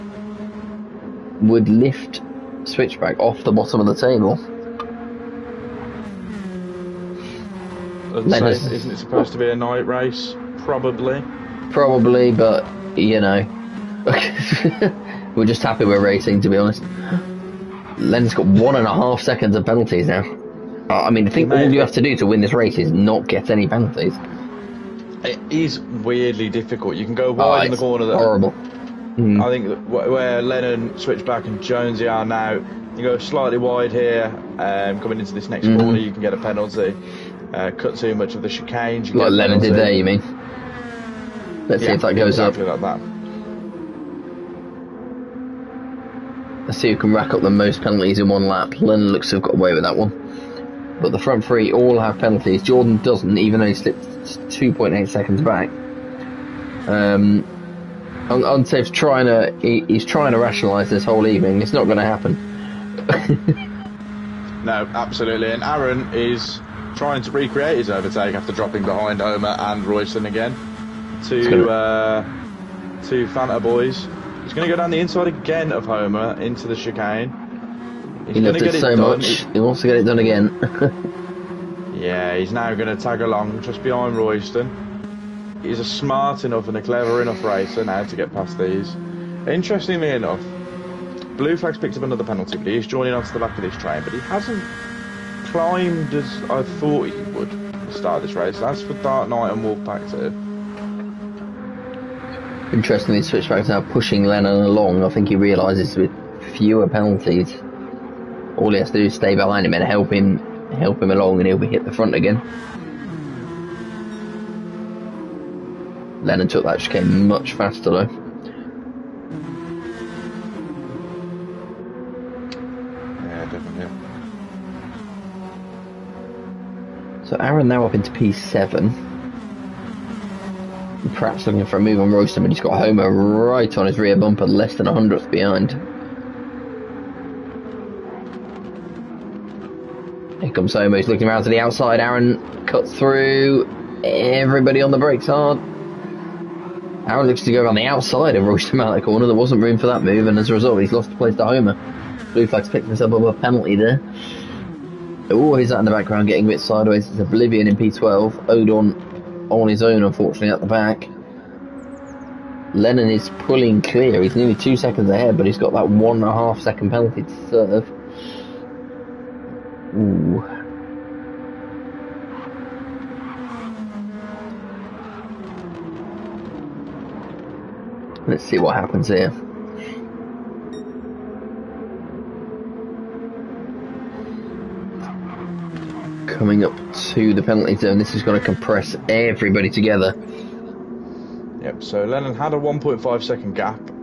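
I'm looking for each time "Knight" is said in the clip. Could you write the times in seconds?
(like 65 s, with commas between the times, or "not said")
99 s.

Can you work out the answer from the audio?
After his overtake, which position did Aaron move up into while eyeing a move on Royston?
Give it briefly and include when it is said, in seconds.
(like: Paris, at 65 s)
P7, at 128 s.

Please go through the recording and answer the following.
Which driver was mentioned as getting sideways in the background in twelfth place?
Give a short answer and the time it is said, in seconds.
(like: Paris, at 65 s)
Oblivion, at 157 s.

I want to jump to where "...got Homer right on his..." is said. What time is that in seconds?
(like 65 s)
132 s.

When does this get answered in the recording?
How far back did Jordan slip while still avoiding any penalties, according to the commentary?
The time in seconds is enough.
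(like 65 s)
54 s.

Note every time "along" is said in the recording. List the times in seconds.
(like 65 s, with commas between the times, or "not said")
83 s, 104 s, 111 s.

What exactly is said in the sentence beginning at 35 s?
corner, you can get a penalty.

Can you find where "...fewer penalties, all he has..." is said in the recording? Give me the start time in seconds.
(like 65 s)
106 s.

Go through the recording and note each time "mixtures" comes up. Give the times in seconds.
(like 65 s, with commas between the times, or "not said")
not said.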